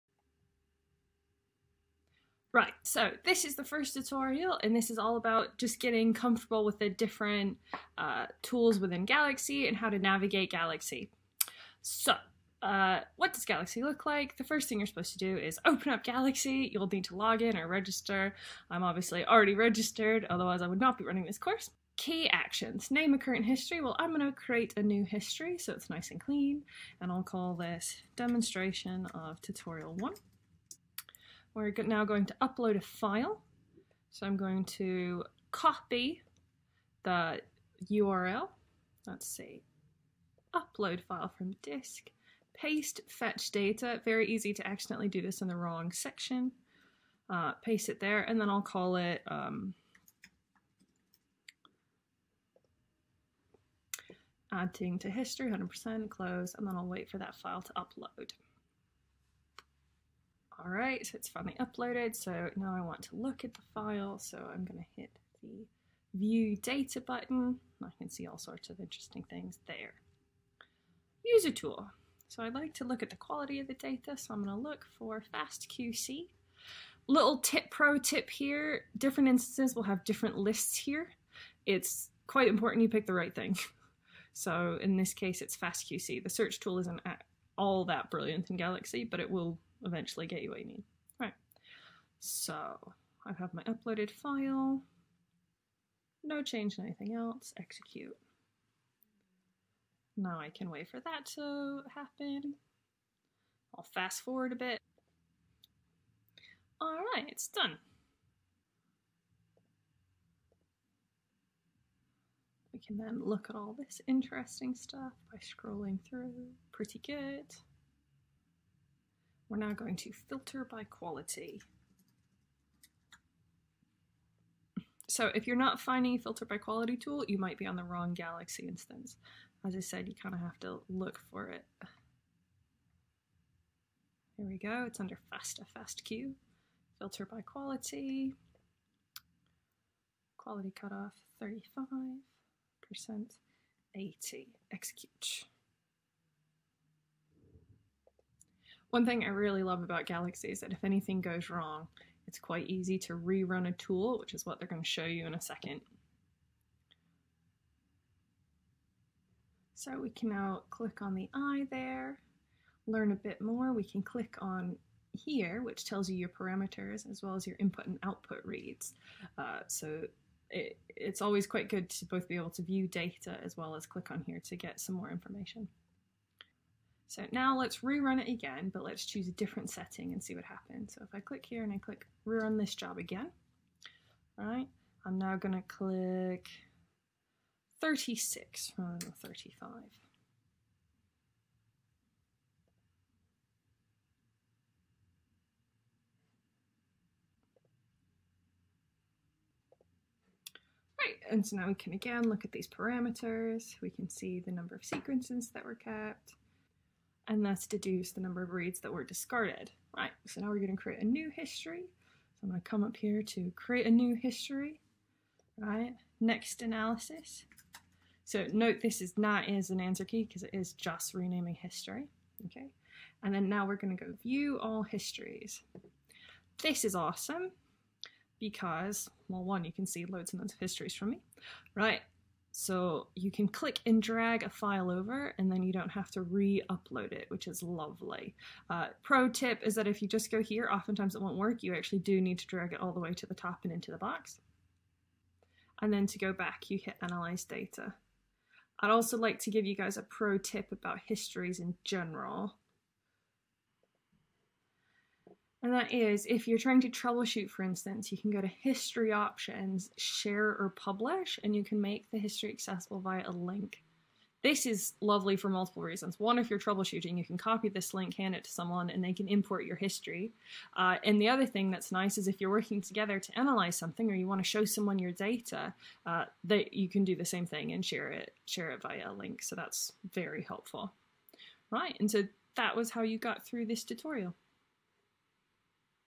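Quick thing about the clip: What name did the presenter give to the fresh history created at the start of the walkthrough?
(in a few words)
Demonstration of Tutorial 1.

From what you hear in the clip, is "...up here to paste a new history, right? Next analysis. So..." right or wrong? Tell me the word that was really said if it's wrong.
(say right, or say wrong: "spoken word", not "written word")
wrong: "create", not "paste".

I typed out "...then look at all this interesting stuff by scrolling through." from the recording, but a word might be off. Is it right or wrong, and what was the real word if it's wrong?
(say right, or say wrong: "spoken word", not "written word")
right.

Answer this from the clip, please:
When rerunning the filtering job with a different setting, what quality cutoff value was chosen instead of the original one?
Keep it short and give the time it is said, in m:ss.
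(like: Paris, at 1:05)
36, at 3:07.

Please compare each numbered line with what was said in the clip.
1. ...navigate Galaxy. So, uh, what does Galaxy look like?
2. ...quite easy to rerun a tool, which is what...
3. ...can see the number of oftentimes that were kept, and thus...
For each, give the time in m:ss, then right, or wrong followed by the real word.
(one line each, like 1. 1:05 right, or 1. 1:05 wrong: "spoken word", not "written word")
1. 0:09 right
2. 2:32 right
3. 3:23 wrong: "sequences", not "oftentimes".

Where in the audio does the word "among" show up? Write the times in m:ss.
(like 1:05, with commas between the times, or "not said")
not said.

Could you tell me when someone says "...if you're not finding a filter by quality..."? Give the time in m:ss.
2:05.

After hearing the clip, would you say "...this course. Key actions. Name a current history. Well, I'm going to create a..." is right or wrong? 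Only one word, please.
right.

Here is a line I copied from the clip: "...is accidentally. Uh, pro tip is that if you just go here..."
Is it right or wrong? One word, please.
wrong.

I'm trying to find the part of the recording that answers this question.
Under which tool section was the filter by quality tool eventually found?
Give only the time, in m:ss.
2:15.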